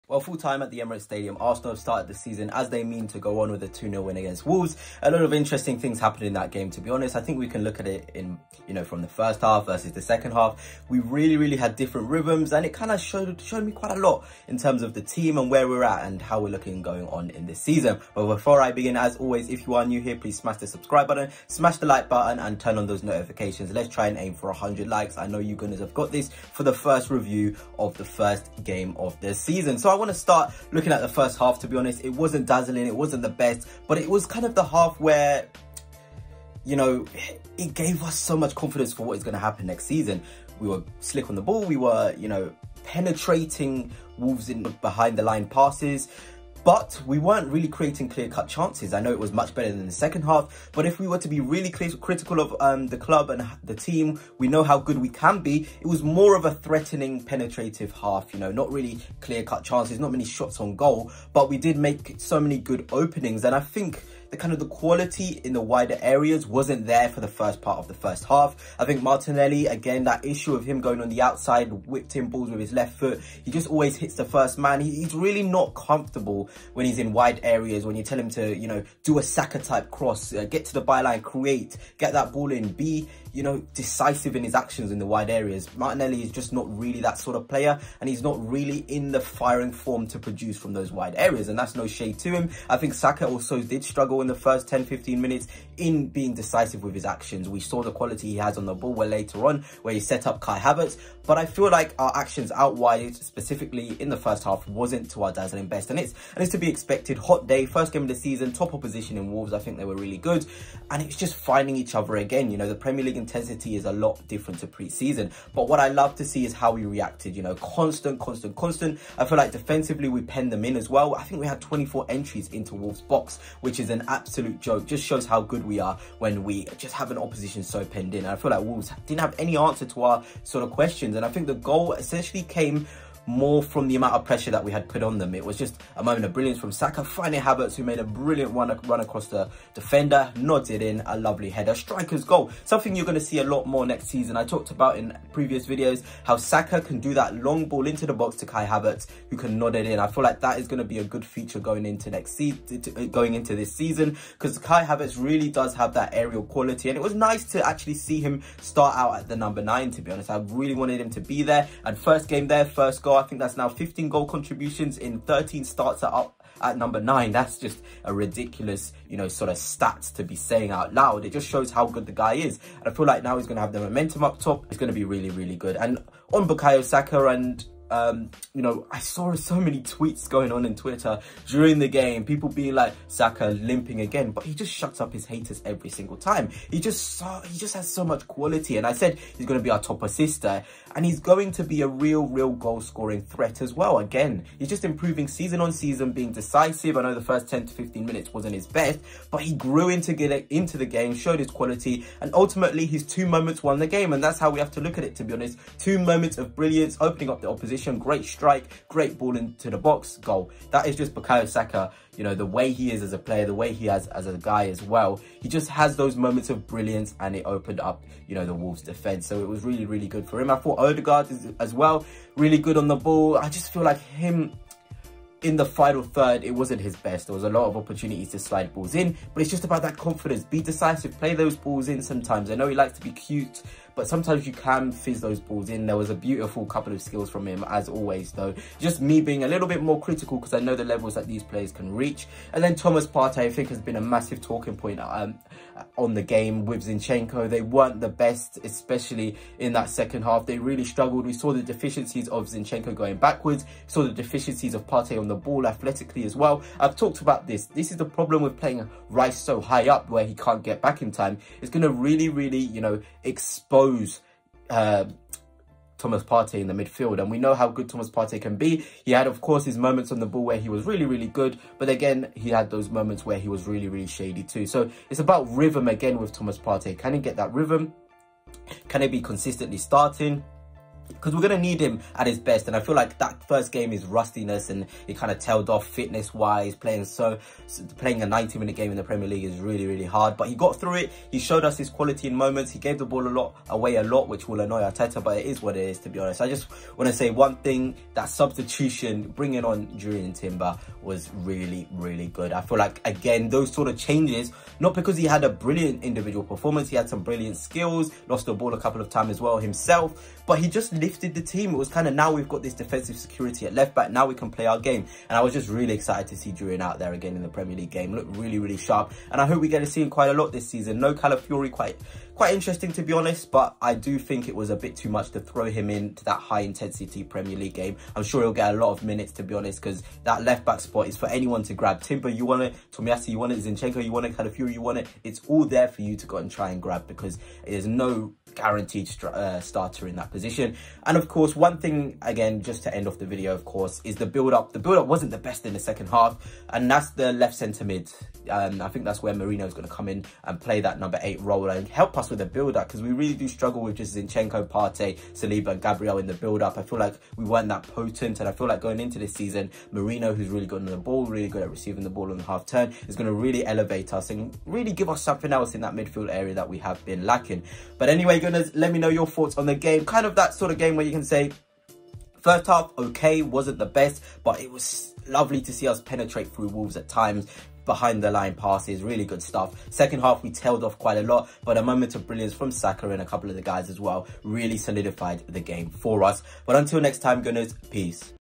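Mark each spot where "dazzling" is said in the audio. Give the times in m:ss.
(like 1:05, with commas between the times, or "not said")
0:32, 1:45.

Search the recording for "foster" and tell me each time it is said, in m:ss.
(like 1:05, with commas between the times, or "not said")
not said.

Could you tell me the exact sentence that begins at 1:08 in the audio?
I think Martinelli, again, that issue of him going on the outside, whipped in balls with his left foot.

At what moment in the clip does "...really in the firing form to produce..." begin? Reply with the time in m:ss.
1:28.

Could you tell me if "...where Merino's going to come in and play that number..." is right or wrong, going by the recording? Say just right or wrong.
right.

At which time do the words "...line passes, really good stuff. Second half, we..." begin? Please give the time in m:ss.
6:18.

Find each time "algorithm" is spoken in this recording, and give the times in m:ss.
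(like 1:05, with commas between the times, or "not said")
not said.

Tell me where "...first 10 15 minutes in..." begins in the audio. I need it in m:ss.
1:34.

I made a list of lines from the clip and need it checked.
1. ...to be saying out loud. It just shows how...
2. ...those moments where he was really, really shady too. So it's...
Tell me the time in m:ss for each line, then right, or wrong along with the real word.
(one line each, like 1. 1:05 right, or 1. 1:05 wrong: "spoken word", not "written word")
1. 2:50 right
2. 4:32 right.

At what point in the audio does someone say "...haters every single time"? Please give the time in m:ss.
3:05.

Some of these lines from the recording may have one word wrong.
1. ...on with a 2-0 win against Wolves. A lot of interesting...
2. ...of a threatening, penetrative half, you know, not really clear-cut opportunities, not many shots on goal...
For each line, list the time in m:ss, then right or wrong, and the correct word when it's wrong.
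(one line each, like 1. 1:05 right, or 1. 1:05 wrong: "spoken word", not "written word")
1. 0:03 right
2. 0:56 wrong: "chances", not "opportunities".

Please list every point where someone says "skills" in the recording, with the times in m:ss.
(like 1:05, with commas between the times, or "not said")
3:57, 5:07.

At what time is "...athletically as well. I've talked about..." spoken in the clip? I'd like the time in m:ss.
4:15.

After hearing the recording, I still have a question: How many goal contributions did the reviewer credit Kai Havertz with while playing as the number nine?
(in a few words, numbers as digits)
15.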